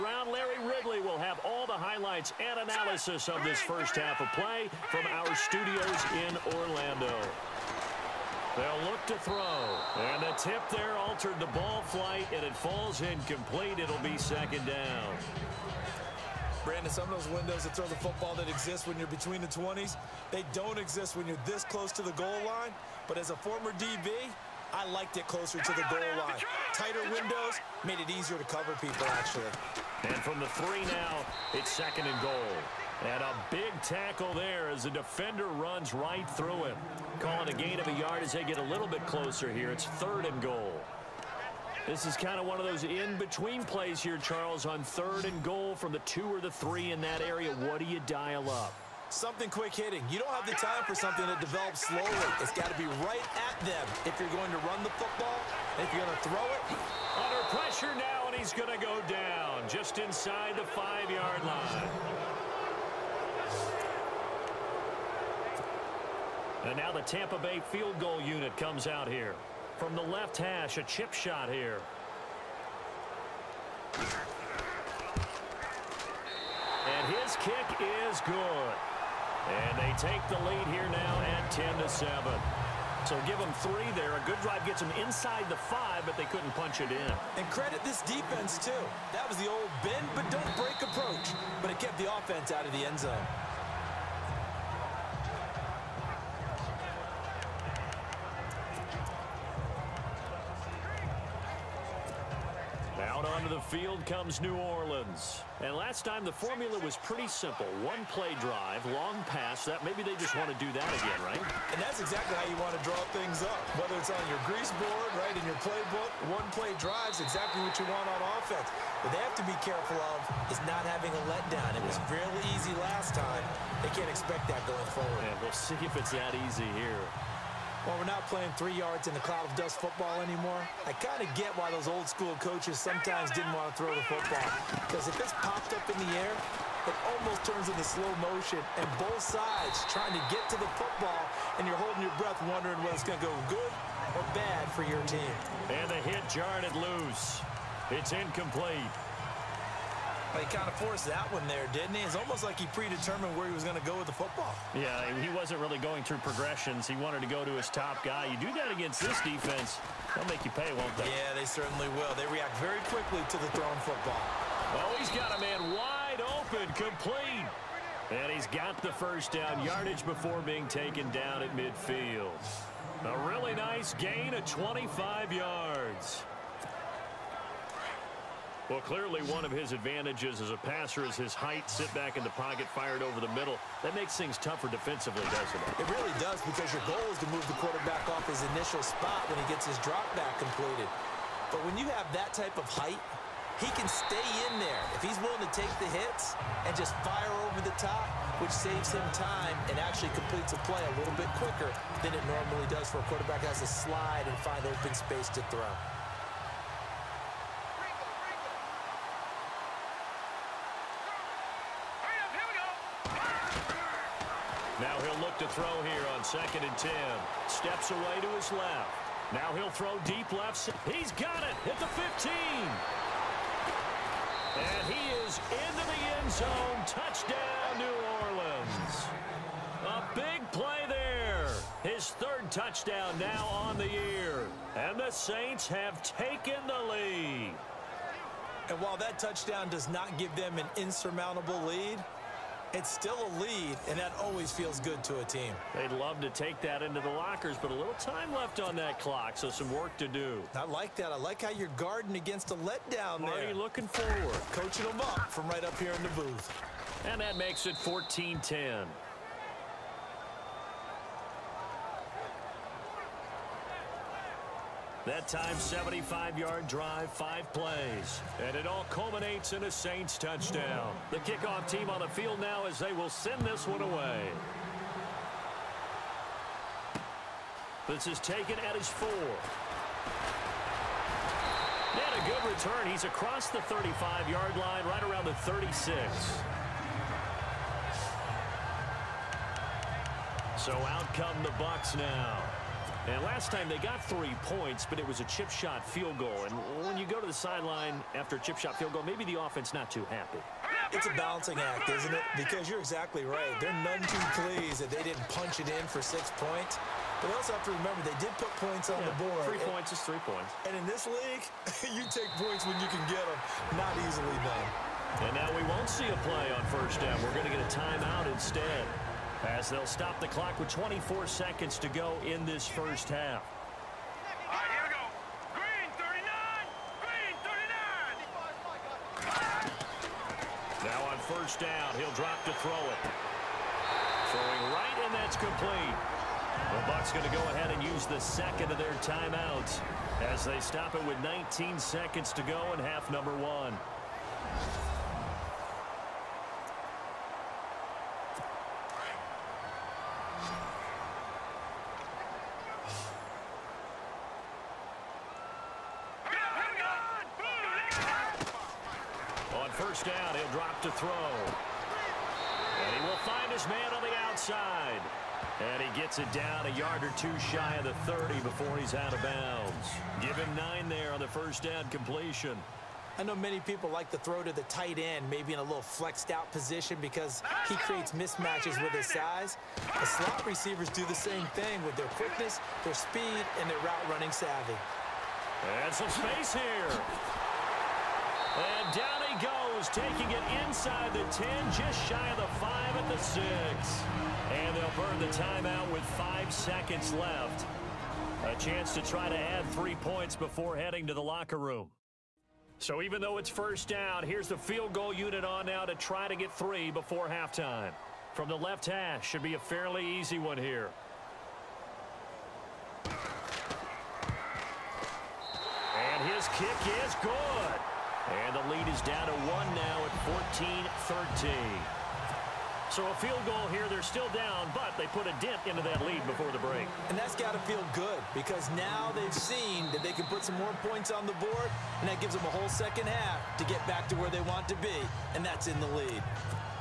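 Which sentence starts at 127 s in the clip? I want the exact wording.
Well, we're not playing three yards in the cloud of dust football anymore.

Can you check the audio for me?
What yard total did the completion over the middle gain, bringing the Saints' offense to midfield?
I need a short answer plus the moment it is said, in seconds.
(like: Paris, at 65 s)
25 yards, at 174 s.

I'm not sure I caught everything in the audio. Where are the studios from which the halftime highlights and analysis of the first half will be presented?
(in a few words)
Orlando.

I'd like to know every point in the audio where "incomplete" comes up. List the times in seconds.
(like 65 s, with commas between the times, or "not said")
13 s, 148 s.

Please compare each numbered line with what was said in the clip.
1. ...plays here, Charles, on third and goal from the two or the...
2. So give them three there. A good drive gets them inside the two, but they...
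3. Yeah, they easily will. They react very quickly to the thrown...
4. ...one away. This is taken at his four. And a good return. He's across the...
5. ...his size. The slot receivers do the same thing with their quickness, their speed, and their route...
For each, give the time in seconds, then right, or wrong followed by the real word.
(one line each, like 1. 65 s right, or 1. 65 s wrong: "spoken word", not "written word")
1. 43 s right
2. 83 s wrong: "five", not "two"
3. 161 s wrong: "certainly", not "easily"
4. 273 s right
5. 378 s right.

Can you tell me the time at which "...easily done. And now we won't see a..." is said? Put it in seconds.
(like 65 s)
314 s.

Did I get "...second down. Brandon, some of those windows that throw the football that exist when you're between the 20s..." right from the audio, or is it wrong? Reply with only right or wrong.
right.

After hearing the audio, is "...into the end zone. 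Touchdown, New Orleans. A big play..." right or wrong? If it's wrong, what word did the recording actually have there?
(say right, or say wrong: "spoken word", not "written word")
right.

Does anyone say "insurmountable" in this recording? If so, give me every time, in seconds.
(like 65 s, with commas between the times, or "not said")
240 s.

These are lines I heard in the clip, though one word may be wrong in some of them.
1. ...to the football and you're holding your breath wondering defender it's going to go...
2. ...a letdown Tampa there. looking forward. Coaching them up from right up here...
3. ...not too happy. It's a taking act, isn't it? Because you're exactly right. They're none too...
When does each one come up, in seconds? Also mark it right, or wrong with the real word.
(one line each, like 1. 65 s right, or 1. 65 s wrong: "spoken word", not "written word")
1. 140 s wrong: "whether", not "defender"
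2. 252 s wrong: "Marty", not "Tampa"
3. 299 s wrong: "balancing", not "taking".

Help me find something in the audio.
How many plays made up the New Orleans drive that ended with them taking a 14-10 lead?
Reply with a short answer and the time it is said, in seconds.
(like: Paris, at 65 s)
5, at 267 s.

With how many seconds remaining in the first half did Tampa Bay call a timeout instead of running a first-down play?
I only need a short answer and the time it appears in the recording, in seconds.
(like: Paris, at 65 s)
24, at 320 s.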